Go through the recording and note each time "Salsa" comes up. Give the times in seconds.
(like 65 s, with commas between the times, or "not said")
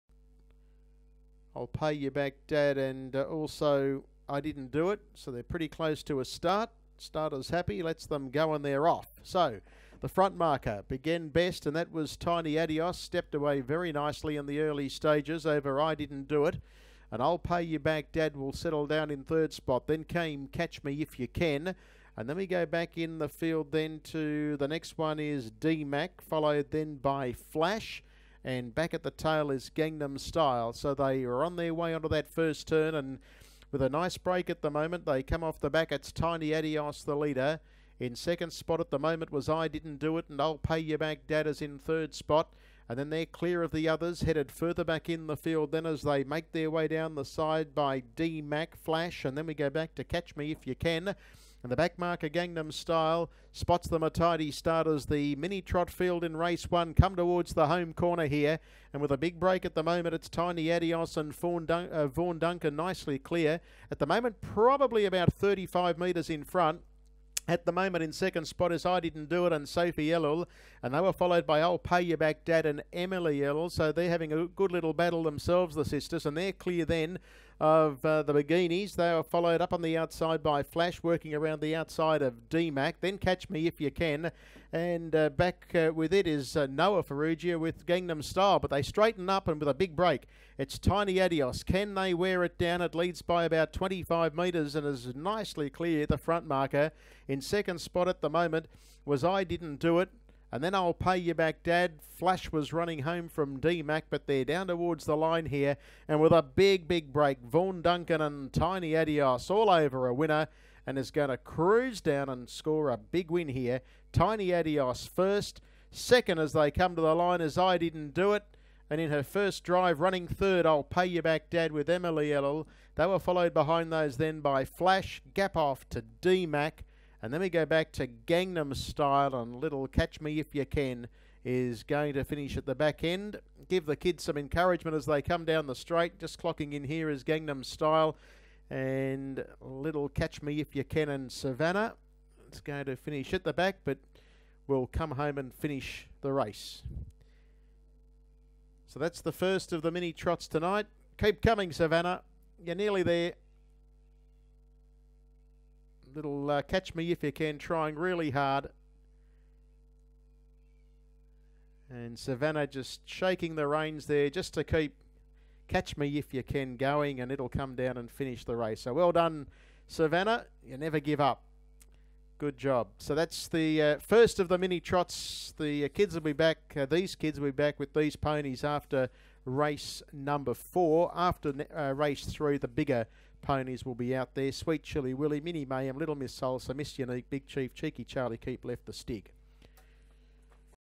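186 s.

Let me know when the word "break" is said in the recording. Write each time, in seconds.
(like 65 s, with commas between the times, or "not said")
34 s, 59 s, 89 s, 107 s.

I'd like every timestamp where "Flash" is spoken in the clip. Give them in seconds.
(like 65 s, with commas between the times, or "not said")
27 s, 48 s, 80 s, 102 s, 124 s.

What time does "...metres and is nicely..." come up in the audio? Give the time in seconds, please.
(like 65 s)
94 s.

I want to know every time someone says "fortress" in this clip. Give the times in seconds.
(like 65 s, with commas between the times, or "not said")
not said.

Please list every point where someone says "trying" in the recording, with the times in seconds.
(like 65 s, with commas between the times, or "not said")
157 s.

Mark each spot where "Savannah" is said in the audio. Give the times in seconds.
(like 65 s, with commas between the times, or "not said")
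141 s, 151 s, 162 s, 169 s.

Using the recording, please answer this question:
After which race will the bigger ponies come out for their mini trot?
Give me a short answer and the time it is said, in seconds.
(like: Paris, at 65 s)
Race three, at 181 s.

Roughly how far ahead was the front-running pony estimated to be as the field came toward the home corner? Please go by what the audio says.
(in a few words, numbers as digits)
35 metres.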